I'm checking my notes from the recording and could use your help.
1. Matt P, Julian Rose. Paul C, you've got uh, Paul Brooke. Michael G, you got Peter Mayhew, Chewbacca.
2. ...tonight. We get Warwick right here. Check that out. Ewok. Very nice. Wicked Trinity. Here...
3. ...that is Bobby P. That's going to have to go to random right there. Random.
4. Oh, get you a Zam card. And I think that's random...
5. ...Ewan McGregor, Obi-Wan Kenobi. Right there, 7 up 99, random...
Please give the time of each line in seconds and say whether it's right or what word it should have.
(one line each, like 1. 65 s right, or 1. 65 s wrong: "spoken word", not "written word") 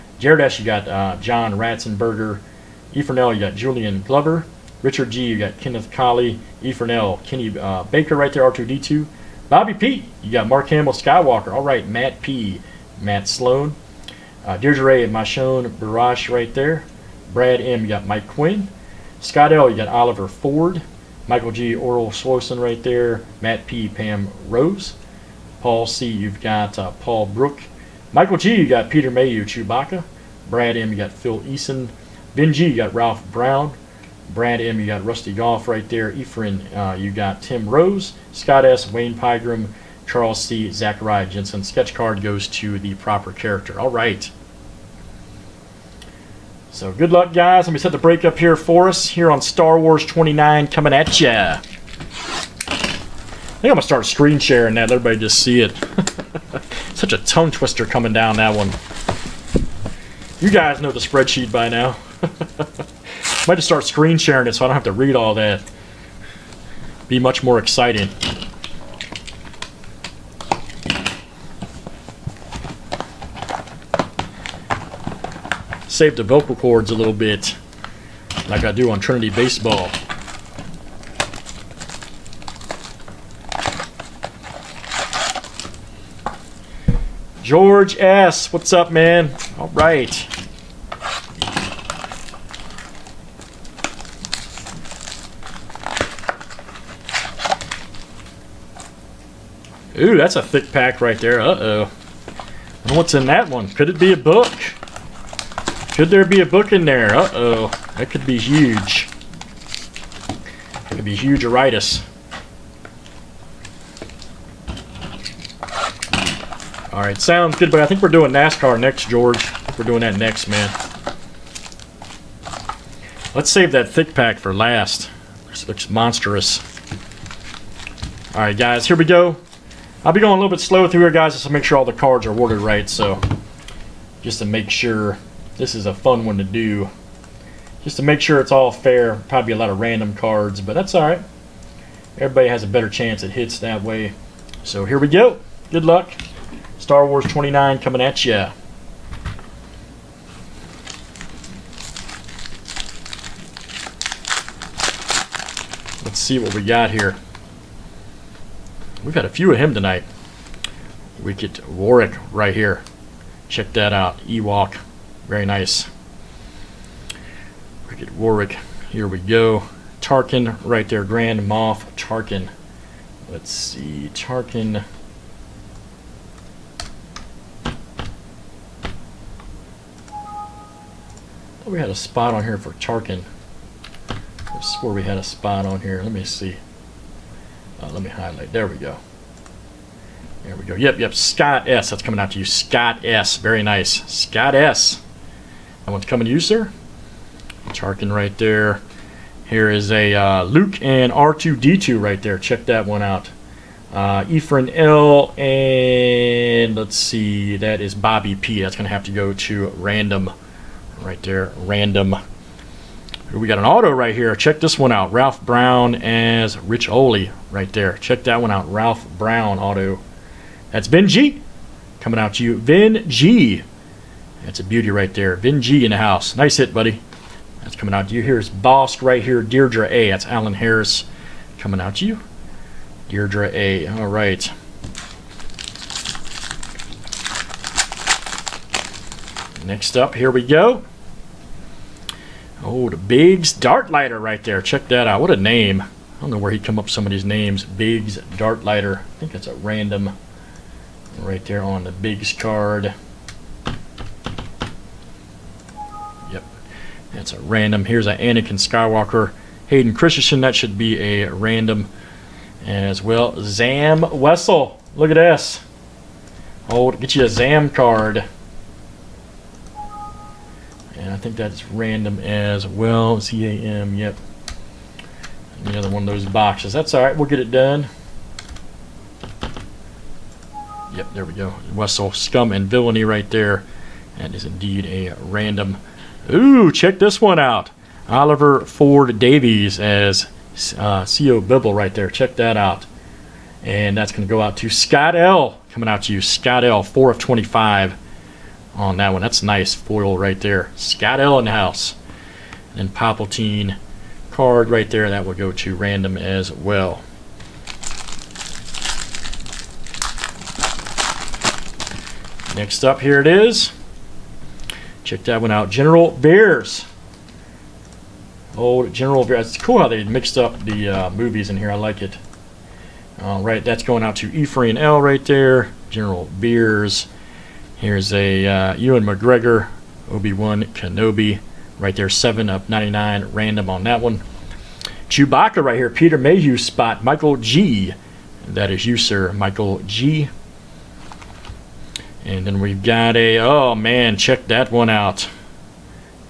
1. 23 s wrong: "Pam", not "Julian"
2. 159 s wrong: "Warwick", not "Trinity"
3. 207 s right
4. 266 s right
5. 328 s right.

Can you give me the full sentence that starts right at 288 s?
Oliver Ford Davies as uh, Sio Bibble right there.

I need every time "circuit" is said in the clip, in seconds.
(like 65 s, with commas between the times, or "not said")
not said.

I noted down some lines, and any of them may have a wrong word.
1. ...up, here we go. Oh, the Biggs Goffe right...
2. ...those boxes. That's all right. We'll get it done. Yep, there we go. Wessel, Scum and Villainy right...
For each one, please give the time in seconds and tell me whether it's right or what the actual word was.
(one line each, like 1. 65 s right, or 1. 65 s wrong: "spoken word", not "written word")
1. 239 s wrong: "Darklighter", not "Goffe"
2. 276 s right.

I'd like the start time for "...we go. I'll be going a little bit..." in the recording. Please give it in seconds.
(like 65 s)
128 s.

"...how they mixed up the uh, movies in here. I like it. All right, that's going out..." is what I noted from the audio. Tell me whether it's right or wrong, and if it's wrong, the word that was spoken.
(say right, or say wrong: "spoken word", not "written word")
right.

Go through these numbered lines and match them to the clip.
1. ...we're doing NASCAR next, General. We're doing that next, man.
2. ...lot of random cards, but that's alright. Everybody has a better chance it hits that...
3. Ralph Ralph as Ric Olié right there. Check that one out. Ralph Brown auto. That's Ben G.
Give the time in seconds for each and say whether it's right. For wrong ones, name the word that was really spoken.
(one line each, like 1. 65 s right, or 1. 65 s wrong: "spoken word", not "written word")
1. 118 s wrong: "George", not "General"
2. 139 s right
3. 215 s wrong: "Brown", not "Ralph".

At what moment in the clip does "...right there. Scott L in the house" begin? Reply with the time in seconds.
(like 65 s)
300 s.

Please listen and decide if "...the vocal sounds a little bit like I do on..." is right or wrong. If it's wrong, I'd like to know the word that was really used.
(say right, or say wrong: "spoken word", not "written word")
wrong: "cords", not "sounds".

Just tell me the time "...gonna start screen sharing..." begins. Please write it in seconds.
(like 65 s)
53 s.